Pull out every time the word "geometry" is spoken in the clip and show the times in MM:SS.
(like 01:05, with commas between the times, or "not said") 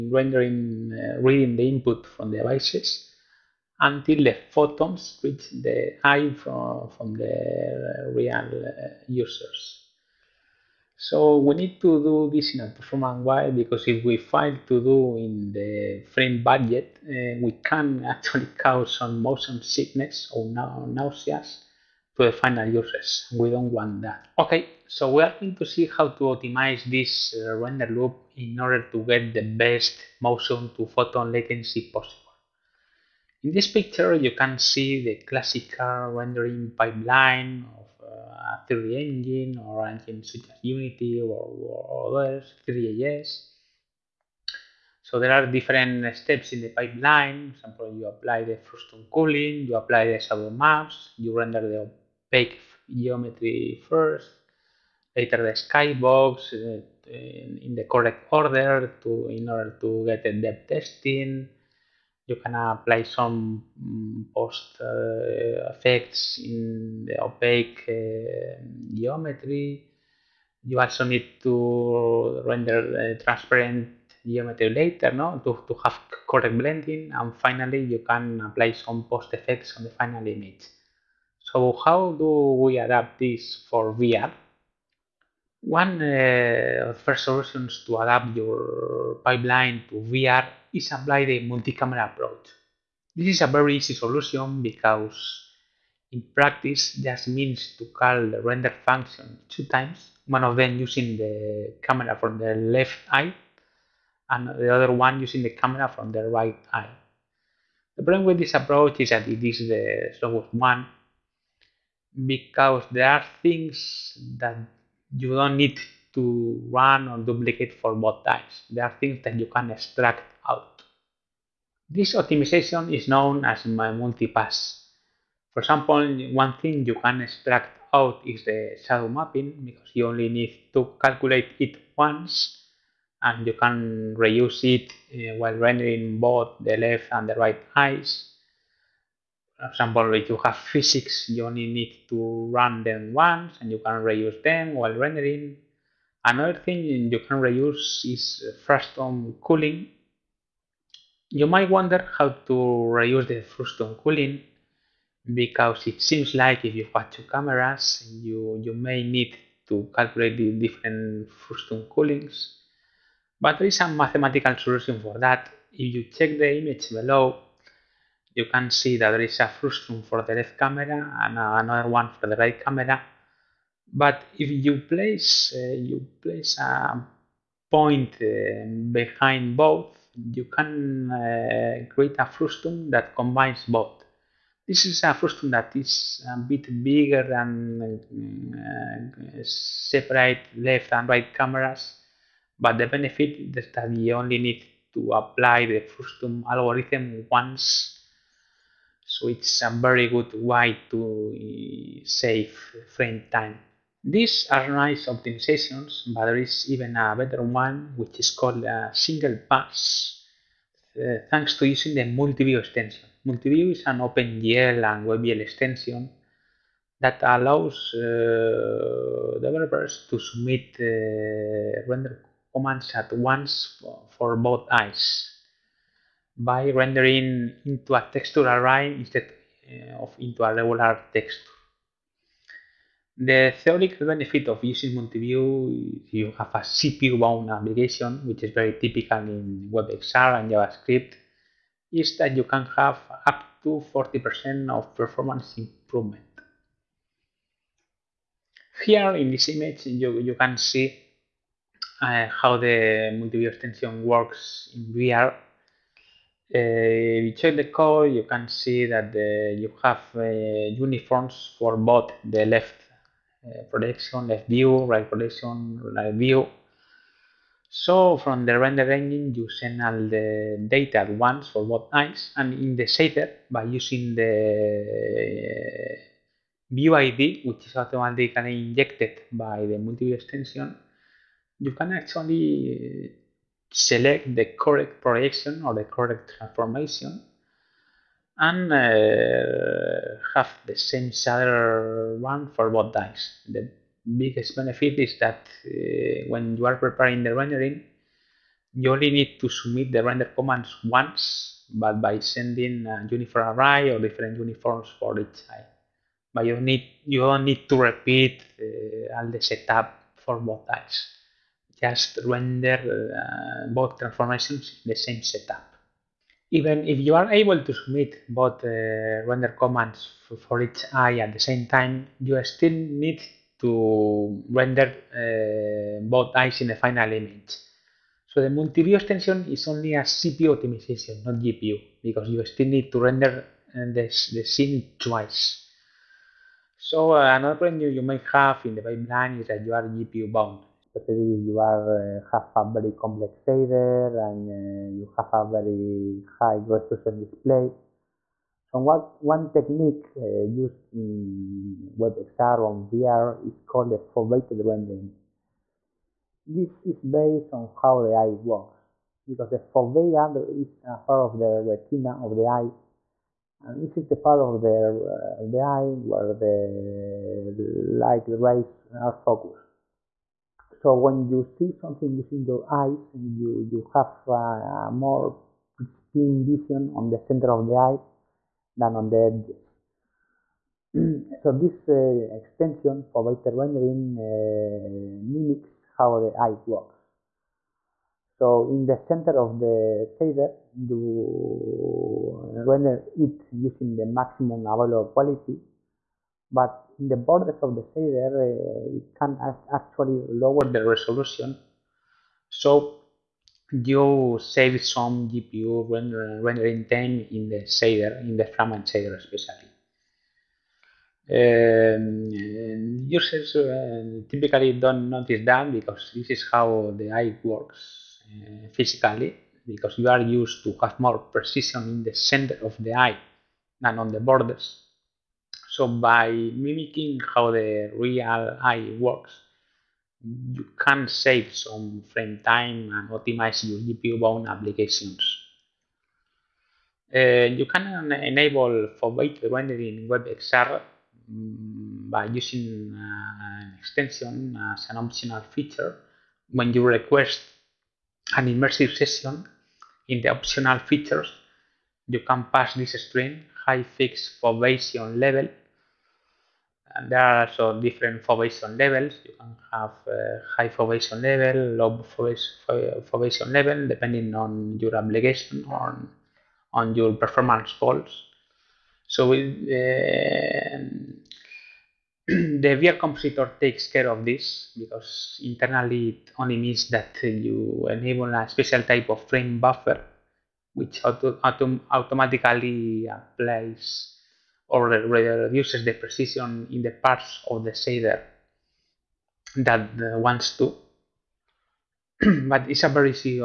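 00:53, 01:08, 01:14.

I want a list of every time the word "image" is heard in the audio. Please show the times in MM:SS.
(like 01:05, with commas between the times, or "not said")
01:20, 02:46, 04:09, 05:27.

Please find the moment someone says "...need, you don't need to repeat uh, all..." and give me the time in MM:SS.
05:06.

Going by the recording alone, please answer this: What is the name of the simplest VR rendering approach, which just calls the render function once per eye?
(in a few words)
multi-camera approach.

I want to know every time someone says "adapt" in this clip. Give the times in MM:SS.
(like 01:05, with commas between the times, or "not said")
01:22, 01:27.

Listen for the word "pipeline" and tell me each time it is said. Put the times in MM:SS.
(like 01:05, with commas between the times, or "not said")
00:36, 00:46, 01:29, 05:38.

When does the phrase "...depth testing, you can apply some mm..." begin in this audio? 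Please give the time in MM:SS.
01:00.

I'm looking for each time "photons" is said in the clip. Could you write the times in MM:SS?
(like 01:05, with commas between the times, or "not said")
00:04, 00:30.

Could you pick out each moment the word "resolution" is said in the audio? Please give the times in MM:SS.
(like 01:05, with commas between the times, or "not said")
05:46, 06:40.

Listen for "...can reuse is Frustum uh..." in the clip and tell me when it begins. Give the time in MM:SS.
02:27.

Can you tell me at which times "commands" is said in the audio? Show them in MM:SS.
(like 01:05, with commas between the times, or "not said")
03:42, 05:00, 05:19.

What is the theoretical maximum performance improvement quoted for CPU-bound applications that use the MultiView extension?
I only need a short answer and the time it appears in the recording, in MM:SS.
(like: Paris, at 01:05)
40%, at 04:03.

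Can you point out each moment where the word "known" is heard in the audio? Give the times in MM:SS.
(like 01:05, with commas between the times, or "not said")
02:03.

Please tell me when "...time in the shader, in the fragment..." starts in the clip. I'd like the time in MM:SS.
06:46.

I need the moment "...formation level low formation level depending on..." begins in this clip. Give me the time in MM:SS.
07:40.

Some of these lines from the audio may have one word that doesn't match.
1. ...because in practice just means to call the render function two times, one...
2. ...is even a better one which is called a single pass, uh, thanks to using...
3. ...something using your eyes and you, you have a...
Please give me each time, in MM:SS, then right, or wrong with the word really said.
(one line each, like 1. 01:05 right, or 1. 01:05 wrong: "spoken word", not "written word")
1. 01:34 right
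2. 03:26 right
3. 06:11 right.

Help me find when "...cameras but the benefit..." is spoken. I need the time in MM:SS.
03:11.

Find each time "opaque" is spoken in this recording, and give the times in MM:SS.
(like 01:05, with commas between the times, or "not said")
00:52, 01:07.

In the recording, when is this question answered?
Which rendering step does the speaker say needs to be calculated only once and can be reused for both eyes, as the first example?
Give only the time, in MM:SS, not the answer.
02:08.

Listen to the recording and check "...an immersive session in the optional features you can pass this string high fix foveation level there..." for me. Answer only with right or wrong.
right.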